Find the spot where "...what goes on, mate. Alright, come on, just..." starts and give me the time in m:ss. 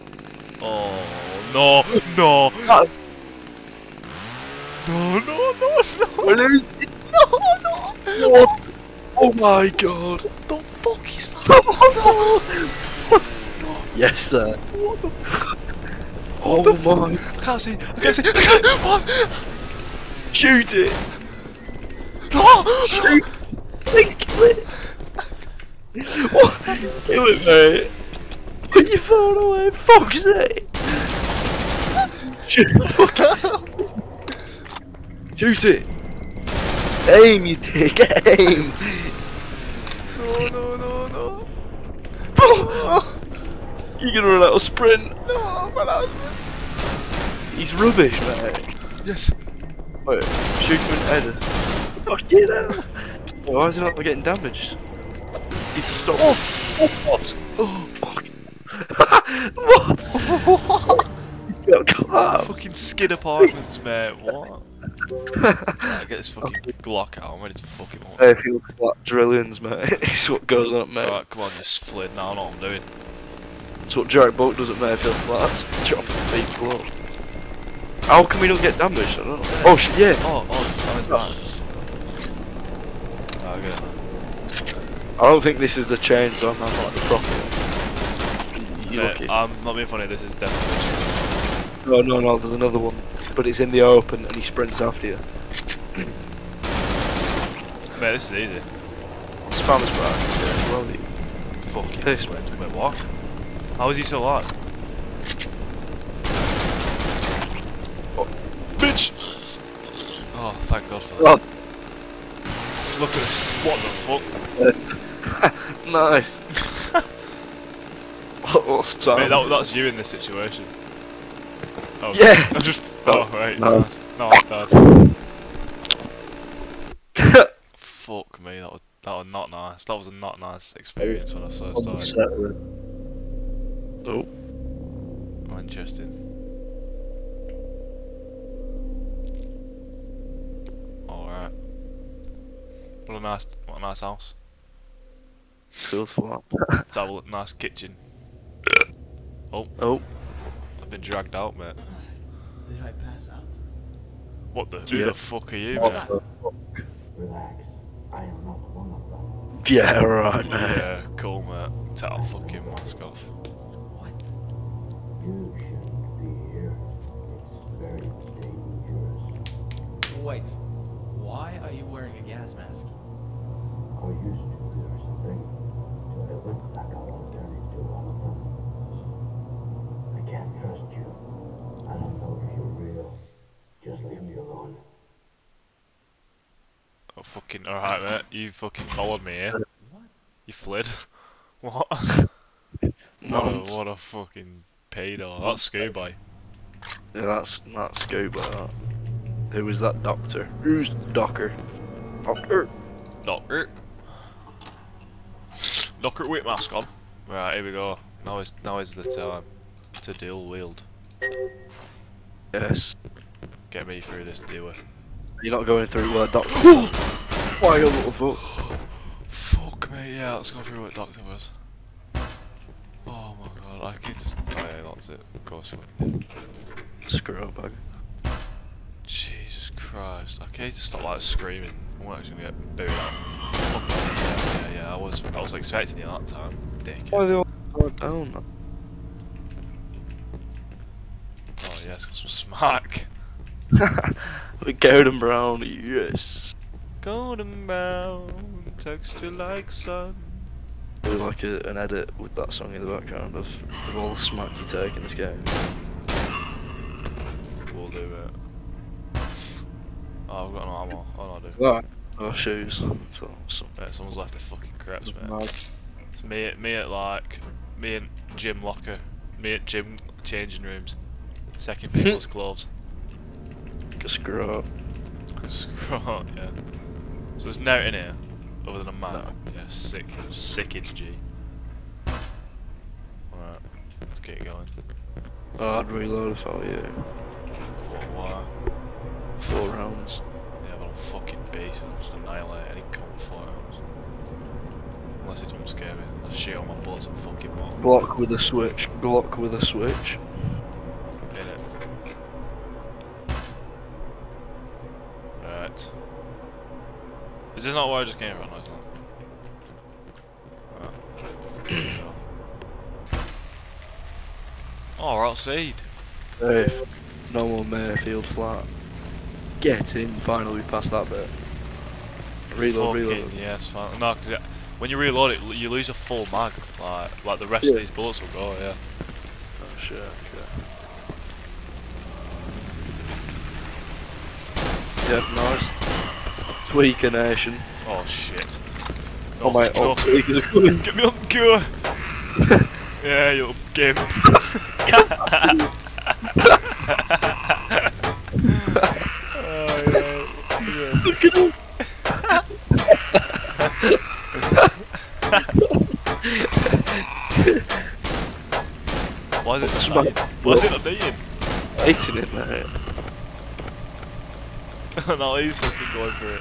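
1:10.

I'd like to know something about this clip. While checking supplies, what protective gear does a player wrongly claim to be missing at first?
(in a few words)
Armor.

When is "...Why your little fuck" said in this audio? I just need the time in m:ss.
3:37.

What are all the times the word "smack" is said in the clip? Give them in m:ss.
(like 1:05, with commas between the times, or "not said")
4:02, 4:14.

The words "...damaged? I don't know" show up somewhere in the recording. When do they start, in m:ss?
1:18.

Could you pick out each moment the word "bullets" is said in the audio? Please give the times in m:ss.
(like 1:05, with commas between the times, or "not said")
4:56, 5:27.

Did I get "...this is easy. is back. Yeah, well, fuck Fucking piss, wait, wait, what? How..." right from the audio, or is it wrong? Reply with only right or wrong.
right.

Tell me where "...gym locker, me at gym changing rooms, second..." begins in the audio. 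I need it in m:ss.
4:28.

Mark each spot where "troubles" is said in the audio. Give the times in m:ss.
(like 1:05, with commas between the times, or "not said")
not said.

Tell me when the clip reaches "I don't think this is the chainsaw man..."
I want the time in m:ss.
1:25.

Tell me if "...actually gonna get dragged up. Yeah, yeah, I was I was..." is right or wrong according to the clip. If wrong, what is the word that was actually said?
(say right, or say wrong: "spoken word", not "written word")
wrong: "booed", not "dragged".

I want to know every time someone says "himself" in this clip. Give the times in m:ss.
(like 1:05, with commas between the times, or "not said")
not said.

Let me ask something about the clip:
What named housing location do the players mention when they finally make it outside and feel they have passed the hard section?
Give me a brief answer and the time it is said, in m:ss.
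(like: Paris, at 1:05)
Mayfield Flats, at 5:17.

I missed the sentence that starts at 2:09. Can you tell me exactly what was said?
That was a not nice experience when I first started.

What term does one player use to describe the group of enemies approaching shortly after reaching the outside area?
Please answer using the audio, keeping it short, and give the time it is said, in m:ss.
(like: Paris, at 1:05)
Tweaker nation, at 5:36.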